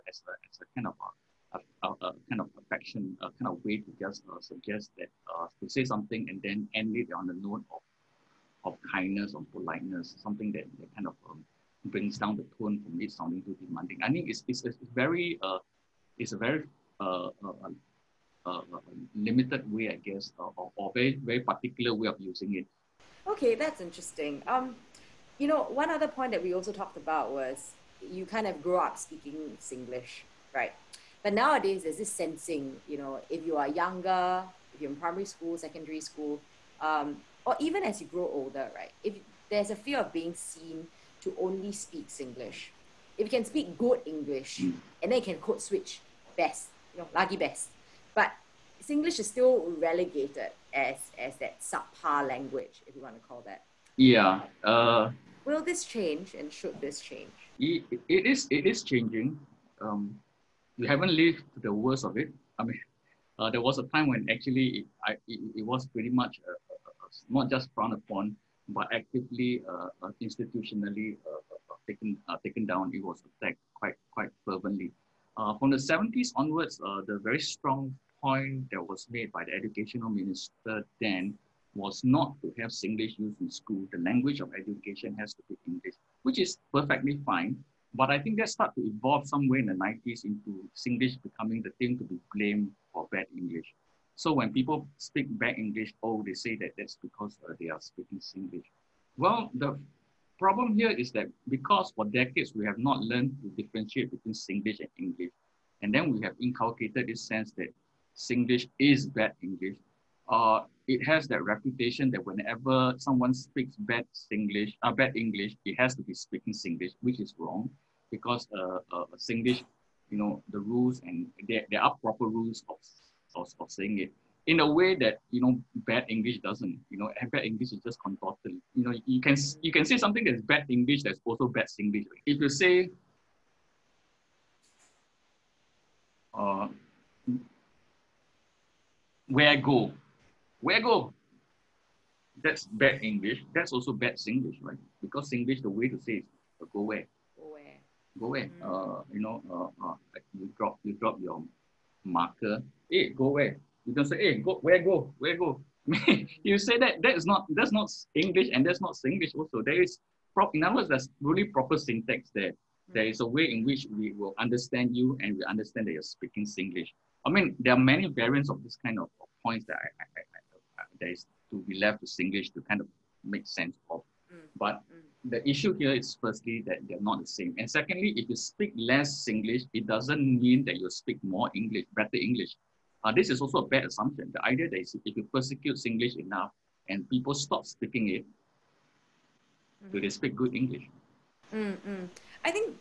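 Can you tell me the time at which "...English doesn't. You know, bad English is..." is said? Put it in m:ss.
2:06.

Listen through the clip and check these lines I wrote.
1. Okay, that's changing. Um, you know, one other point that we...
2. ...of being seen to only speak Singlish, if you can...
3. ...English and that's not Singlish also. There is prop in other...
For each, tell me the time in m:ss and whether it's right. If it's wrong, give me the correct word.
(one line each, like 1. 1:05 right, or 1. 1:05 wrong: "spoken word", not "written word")
1. 0:23 wrong: "interesting", not "changing"
2. 0:39 right
3. 2:38 right.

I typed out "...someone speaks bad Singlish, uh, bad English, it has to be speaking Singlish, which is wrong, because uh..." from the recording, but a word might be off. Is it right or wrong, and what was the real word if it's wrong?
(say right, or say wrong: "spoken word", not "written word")
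right.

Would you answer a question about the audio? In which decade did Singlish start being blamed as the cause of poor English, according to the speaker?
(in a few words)
the 90s.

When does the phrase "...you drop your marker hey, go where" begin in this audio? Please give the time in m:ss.
2:30.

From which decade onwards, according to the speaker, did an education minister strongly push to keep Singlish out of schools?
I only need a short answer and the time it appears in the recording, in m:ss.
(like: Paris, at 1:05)
the 70s, at 1:15.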